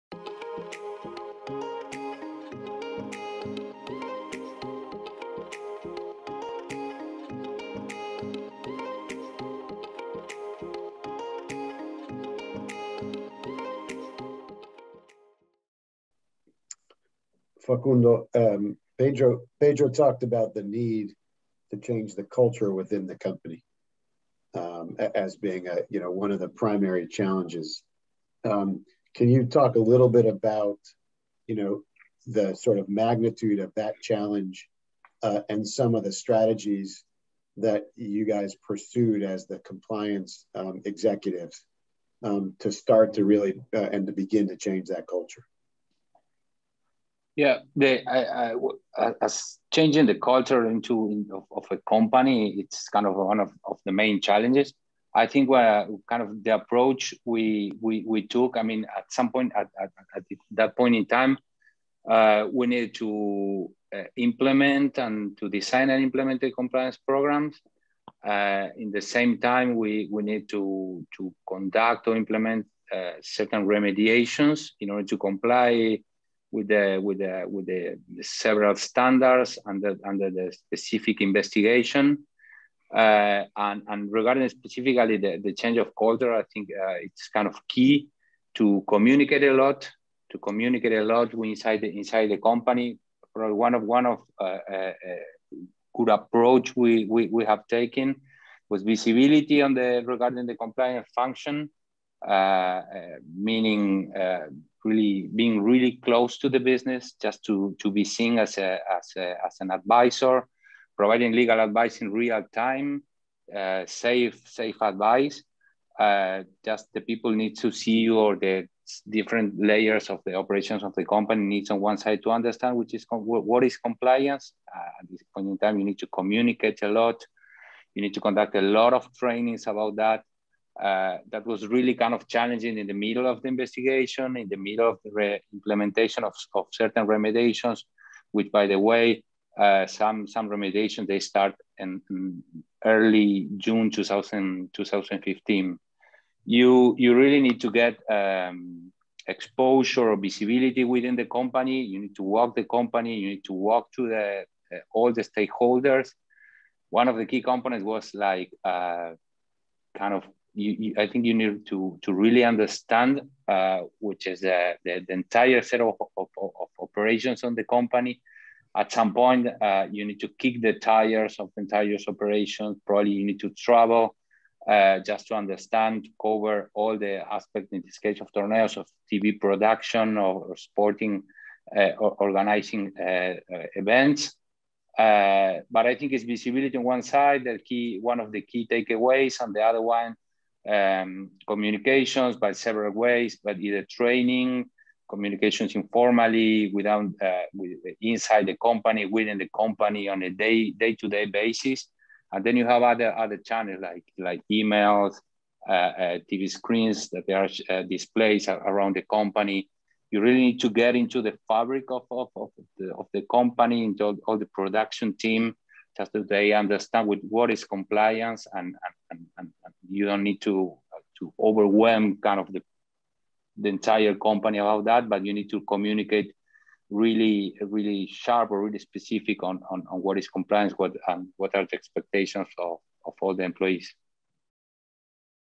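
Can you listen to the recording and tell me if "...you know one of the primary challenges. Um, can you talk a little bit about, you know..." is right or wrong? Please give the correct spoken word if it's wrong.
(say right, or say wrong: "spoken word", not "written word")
right.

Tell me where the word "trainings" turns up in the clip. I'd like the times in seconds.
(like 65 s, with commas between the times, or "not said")
129 s, 193 s.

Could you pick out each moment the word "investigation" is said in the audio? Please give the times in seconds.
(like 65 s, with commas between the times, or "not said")
81 s, 133 s.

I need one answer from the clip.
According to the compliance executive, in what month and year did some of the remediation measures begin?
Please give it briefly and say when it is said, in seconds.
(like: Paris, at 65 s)
June 2015, at 143 s.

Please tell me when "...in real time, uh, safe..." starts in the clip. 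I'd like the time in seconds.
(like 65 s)
112 s.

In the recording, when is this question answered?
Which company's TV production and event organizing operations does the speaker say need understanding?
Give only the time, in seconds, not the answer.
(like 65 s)
178 s.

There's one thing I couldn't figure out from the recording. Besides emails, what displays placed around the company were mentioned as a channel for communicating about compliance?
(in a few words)
TV screens.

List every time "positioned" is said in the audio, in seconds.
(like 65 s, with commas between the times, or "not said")
not said.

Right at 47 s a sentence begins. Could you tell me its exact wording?
Yeah, the, I, I, as changing the culture into of, of, a company, it's kind of one of, of the main challenges.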